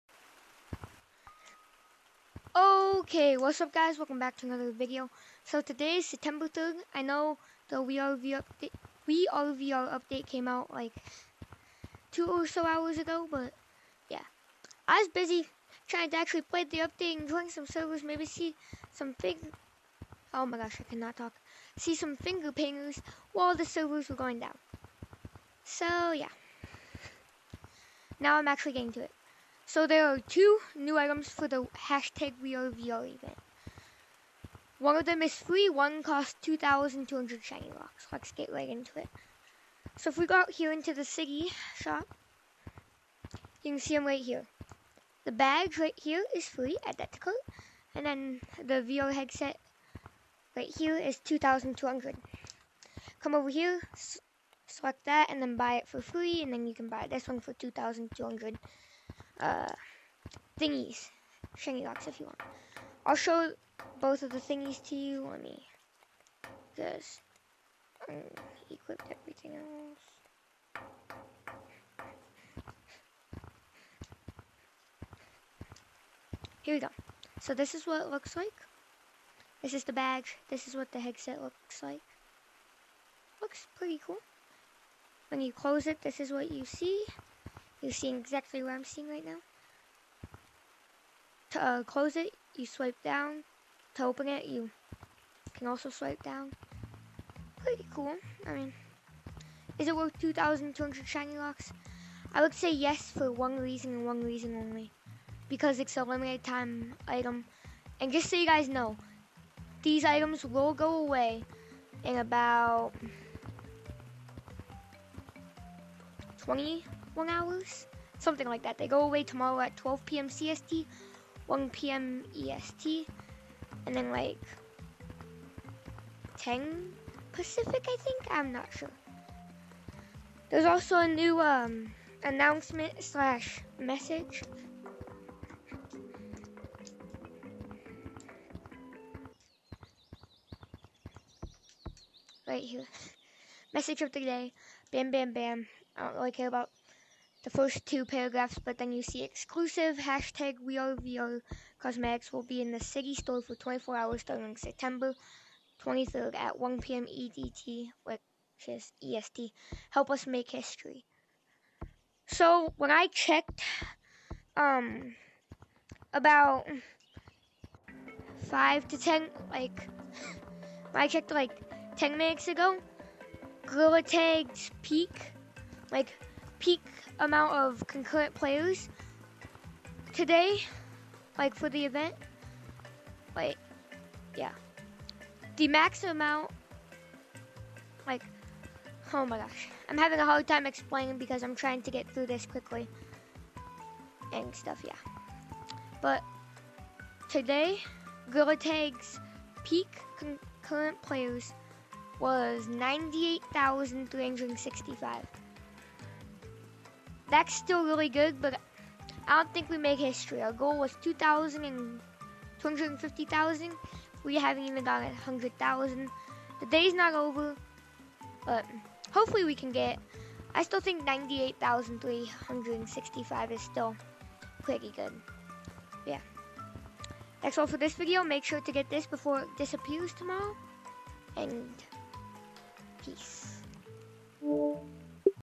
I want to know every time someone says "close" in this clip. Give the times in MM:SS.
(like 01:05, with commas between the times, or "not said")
01:25, 01:31.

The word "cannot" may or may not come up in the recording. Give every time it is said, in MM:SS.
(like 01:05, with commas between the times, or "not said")
00:20.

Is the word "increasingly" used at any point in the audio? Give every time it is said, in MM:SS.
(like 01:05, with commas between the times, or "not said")
not said.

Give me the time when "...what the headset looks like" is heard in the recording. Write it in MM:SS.
01:20.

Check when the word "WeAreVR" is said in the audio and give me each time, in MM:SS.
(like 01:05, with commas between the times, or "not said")
00:32, 02:30.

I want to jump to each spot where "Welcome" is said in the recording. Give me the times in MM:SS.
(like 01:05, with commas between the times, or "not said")
00:03.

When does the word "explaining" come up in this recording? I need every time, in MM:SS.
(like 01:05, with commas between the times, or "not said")
03:10.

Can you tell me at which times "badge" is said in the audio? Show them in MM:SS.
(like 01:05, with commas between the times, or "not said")
00:45, 01:19.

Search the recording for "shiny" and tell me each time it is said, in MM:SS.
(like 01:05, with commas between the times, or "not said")
00:37, 01:01, 01:41.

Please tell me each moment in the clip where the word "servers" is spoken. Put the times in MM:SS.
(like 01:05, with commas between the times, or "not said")
00:17, 00:23.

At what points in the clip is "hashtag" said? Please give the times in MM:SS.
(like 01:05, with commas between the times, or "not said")
00:31, 02:29.